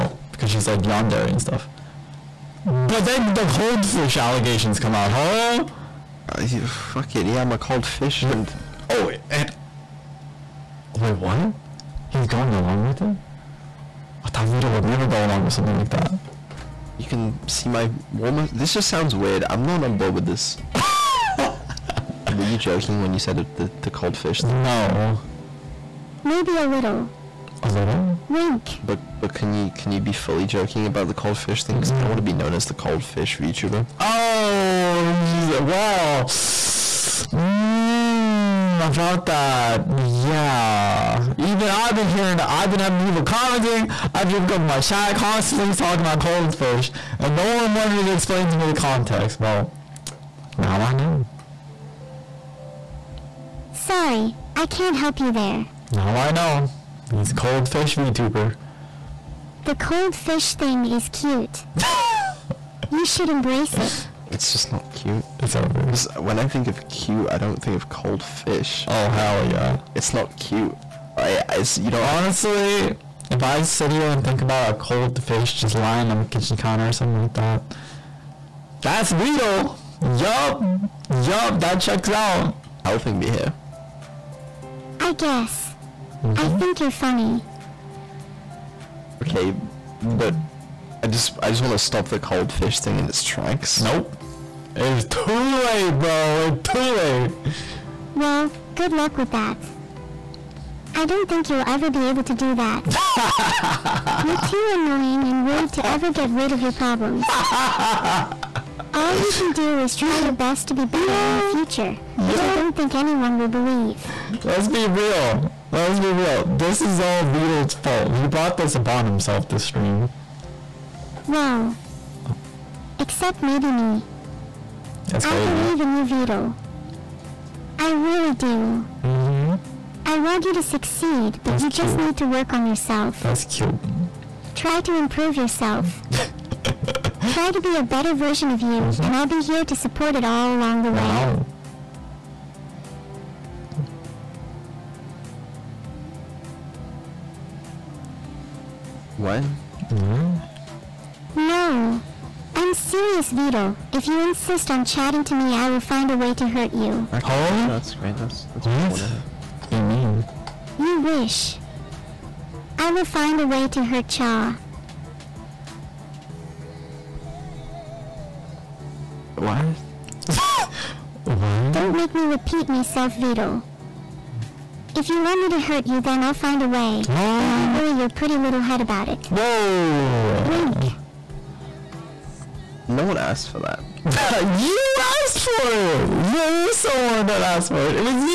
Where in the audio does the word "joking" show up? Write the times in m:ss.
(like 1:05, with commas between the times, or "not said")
0:22, 0:30.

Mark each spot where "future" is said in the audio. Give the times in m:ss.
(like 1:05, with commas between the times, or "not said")
1:51.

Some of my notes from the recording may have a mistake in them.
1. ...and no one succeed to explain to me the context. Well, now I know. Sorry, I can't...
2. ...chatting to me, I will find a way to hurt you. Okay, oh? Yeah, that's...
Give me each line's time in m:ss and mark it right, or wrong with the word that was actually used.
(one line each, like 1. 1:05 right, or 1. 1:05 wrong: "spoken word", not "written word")
1. 0:47 wrong: "wanted", not "succeed"
2. 2:34 right.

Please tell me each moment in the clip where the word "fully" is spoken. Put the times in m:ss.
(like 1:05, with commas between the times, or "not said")
0:30.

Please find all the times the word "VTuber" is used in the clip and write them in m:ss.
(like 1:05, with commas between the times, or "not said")
0:33, 0:57.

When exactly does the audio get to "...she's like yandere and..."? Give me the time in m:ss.
0:00.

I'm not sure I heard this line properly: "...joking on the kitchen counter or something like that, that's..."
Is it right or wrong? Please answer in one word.
wrong.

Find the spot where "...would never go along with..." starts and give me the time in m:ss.
0:14.